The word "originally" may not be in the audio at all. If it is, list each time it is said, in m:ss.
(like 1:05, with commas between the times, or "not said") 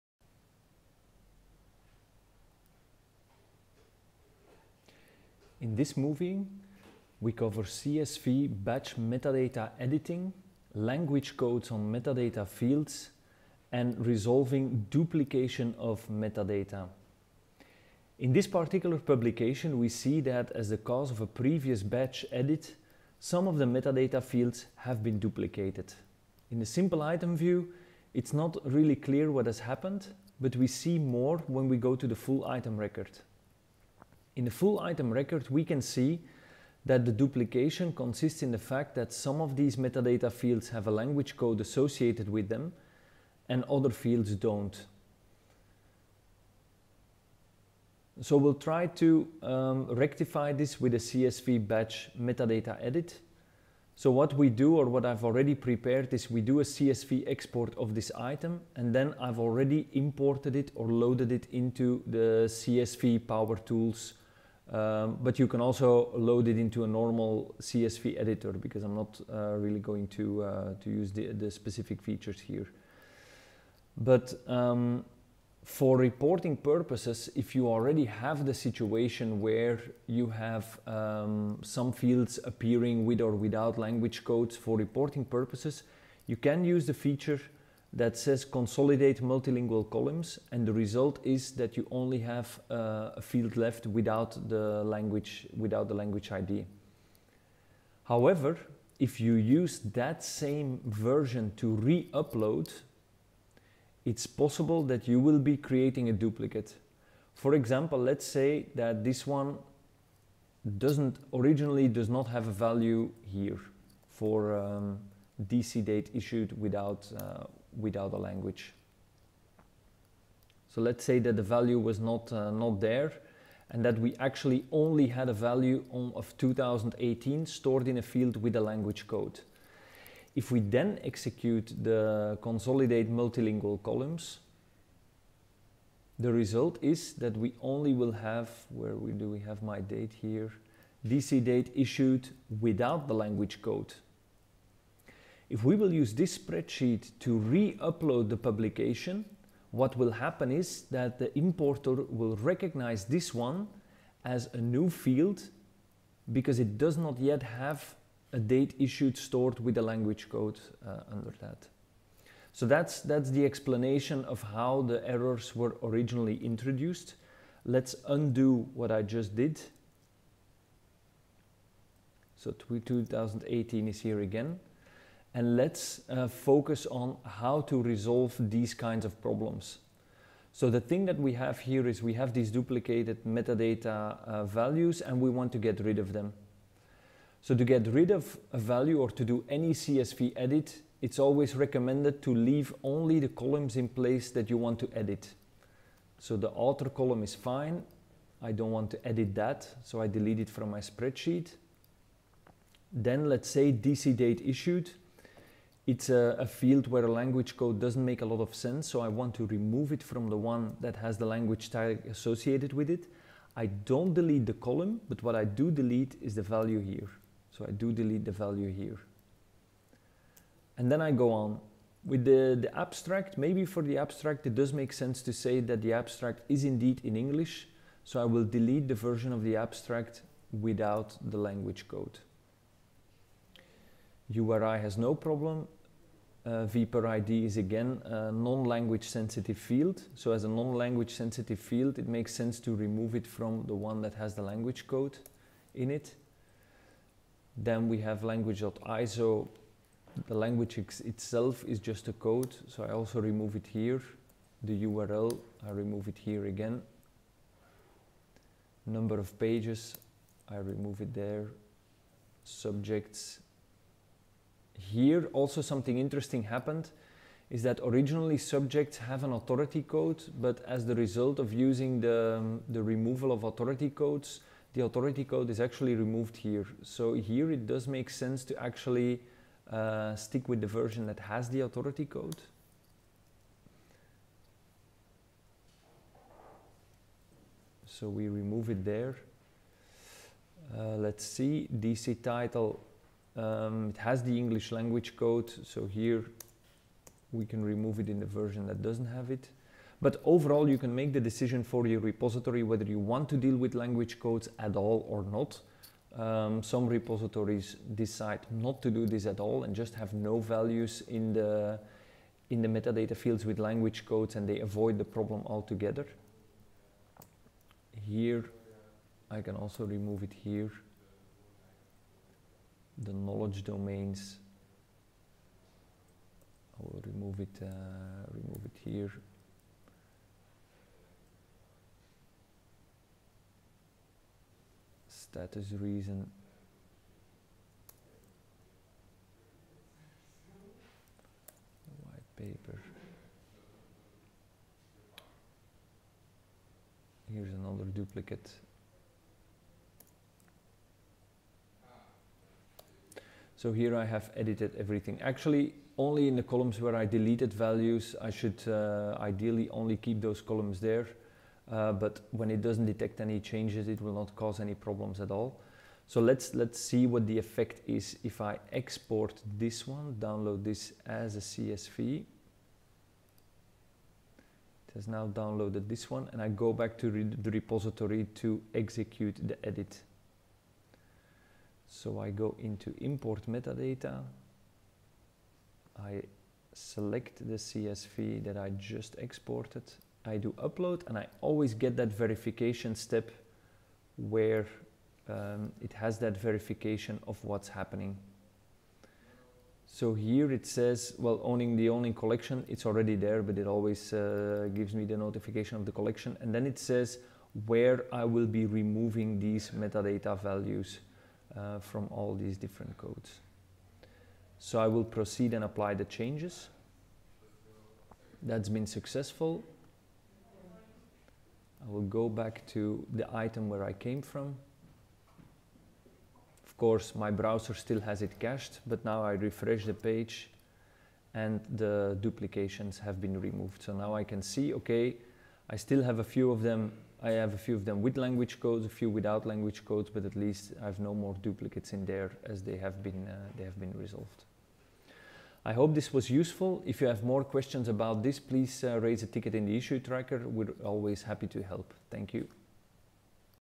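1:51, 2:45, 4:27.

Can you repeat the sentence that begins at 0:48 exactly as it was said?
So we'll try to um, rectify this with a CSV batch metadata edit.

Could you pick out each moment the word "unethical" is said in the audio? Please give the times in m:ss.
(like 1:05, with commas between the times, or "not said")
not said.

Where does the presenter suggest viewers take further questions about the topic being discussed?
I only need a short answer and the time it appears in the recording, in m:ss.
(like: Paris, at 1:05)
issue tracker, at 7:29.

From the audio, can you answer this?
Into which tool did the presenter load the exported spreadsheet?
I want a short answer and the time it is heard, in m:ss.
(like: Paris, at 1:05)
CSV Power Tools, at 1:02.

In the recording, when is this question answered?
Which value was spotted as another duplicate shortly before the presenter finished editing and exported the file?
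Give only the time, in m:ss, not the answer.
5:42.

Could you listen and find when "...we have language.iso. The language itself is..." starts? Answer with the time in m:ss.
4:07.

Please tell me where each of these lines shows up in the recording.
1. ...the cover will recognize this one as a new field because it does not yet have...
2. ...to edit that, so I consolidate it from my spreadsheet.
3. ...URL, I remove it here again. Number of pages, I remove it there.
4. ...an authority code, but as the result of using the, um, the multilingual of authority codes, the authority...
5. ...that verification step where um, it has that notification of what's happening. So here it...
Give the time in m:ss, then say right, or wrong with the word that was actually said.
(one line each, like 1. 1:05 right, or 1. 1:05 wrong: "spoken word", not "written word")
1. 2:31 wrong: "importer", not "cover"
2. 3:18 wrong: "delete", not "consolidate"
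3. 4:14 right
4. 4:29 wrong: "removal", not "multilingual"
5. 6:31 wrong: "verification", not "notification".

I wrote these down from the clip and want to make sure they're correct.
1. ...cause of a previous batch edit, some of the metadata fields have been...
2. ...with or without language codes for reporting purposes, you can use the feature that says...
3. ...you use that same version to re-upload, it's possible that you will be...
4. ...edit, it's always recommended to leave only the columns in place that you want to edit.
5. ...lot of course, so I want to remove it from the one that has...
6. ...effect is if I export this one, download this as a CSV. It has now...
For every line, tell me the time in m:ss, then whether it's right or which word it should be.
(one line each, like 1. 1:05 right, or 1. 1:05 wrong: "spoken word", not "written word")
1. 0:20 right
2. 1:23 right
3. 1:39 right
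4. 3:10 right
5. 3:28 wrong: "sense", not "course"
6. 6:07 right.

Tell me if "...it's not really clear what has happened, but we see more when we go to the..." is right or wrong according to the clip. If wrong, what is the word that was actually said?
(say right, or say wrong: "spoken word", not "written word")
right.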